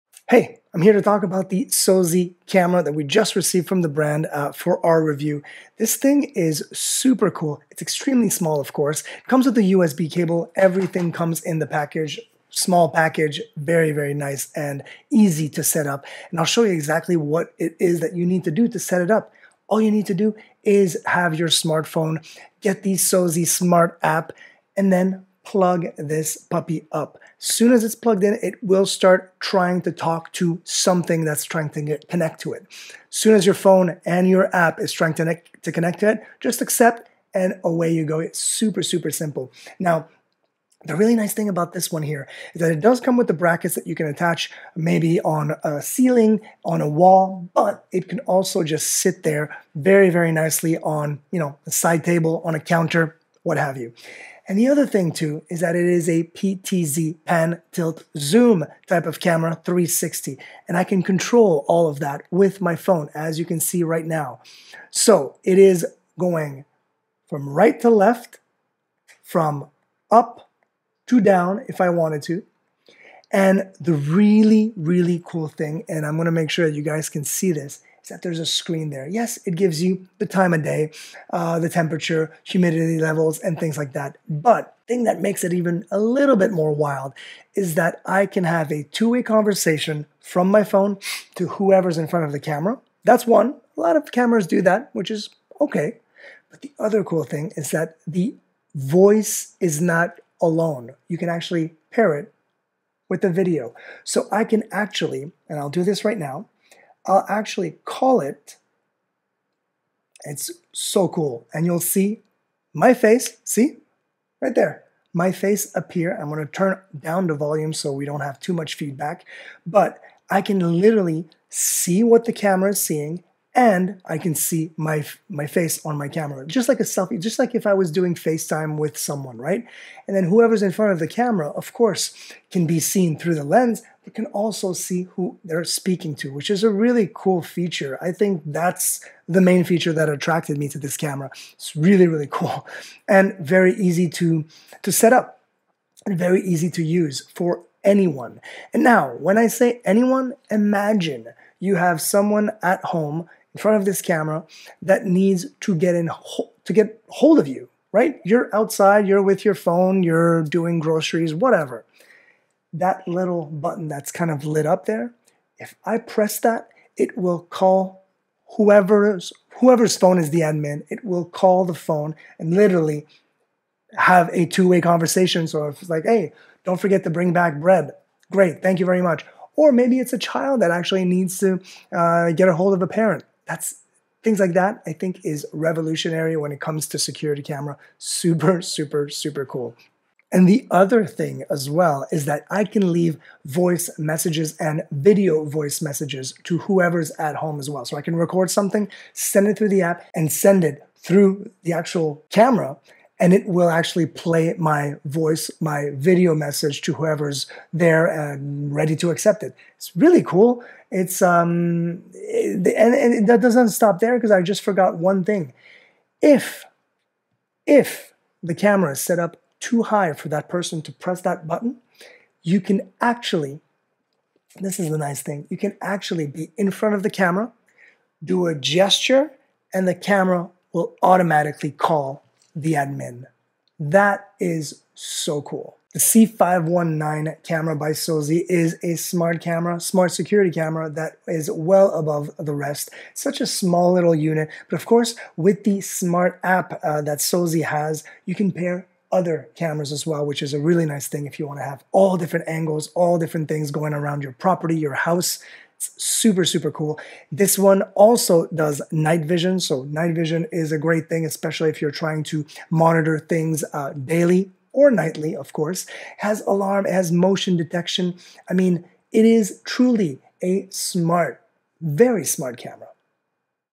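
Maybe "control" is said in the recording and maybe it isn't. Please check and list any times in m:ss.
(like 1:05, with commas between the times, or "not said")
1:01.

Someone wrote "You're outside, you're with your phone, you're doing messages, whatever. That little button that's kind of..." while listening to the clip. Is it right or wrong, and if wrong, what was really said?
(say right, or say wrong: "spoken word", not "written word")
wrong: "groceries", not "messages".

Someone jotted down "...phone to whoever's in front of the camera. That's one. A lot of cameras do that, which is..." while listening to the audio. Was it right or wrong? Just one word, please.
right.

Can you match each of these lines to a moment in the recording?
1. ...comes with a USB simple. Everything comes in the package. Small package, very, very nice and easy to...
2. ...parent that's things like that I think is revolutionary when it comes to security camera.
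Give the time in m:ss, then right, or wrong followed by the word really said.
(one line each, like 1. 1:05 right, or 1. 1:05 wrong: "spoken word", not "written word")
1. 0:09 wrong: "cable", not "simple"
2. 3:02 right.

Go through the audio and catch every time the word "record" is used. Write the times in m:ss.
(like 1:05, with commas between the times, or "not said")
3:18.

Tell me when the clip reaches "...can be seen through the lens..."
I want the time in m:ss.
2:12.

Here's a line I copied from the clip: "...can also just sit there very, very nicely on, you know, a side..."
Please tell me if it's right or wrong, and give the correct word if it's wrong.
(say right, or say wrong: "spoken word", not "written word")
right.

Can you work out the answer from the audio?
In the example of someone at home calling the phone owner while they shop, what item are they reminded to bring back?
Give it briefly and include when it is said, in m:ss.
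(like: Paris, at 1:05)
Bread, at 2:57.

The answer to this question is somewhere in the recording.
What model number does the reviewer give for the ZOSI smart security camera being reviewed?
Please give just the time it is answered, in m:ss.
3:55.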